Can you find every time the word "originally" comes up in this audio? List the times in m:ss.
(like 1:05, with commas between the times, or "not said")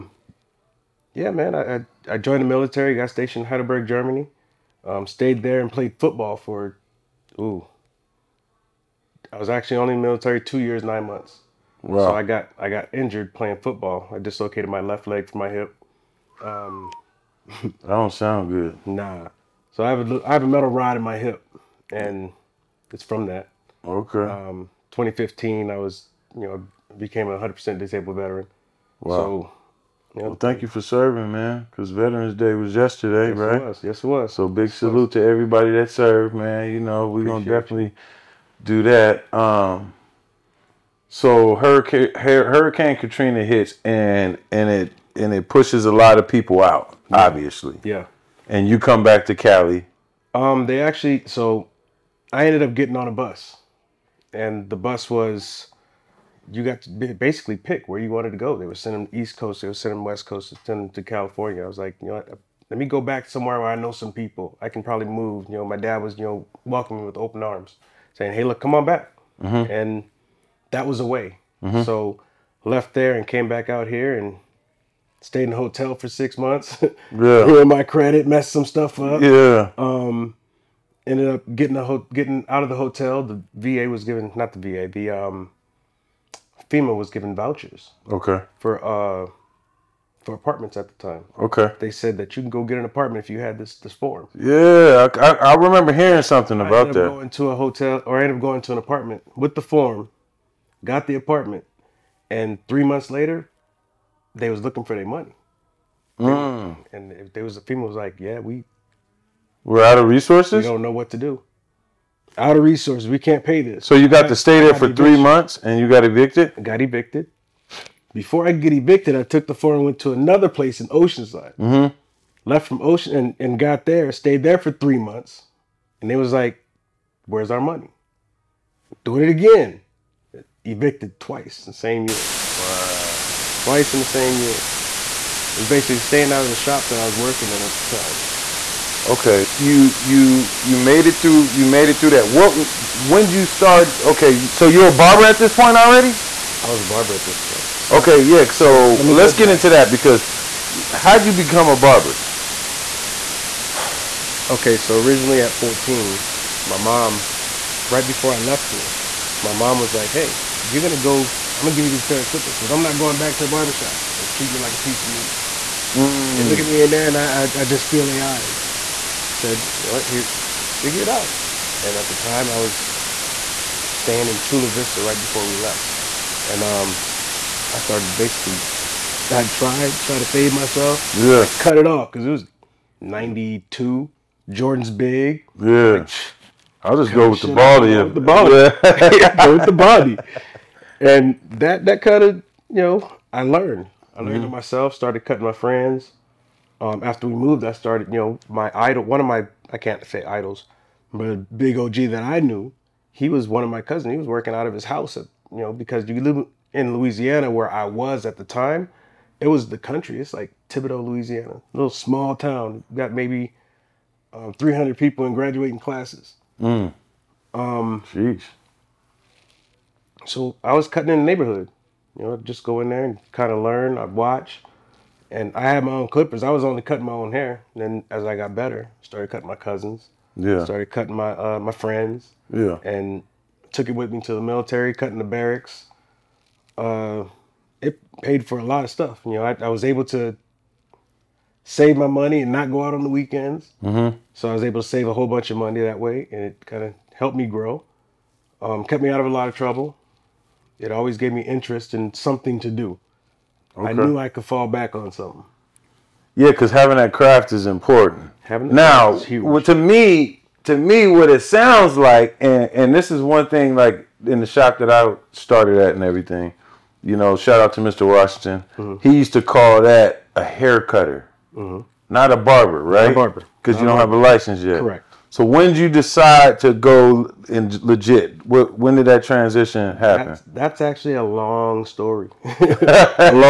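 2:34.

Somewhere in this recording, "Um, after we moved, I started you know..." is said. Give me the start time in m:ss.
3:16.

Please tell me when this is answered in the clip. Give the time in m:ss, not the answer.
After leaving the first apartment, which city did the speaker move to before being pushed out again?
2:00.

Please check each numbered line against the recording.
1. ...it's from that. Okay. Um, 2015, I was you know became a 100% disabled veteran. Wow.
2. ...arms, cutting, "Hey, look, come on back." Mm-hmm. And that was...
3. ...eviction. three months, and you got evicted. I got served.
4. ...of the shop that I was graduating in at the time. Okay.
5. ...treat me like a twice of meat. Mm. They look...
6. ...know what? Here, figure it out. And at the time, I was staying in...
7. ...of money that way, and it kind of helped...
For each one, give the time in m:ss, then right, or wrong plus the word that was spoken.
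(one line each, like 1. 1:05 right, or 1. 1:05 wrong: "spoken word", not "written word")
1. 0:22 right
2. 1:07 wrong: "saying", not "cutting"
3. 1:54 wrong: "evicted", not "served"
4. 2:16 wrong: "working", not "graduating"
5. 2:44 wrong: "piece", not "twice"
6. 2:49 right
7. 4:05 right.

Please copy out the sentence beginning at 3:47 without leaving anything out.
And then as I got better, started cutting my cousins.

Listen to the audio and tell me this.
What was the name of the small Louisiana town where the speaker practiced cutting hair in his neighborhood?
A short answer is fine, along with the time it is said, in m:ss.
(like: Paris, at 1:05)
Thibodaux, at 3:30.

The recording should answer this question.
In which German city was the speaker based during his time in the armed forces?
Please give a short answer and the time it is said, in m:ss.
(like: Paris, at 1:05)
Heidelberg, at 0:03.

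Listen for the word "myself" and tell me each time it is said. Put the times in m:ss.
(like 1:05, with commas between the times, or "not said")
3:00, 3:14.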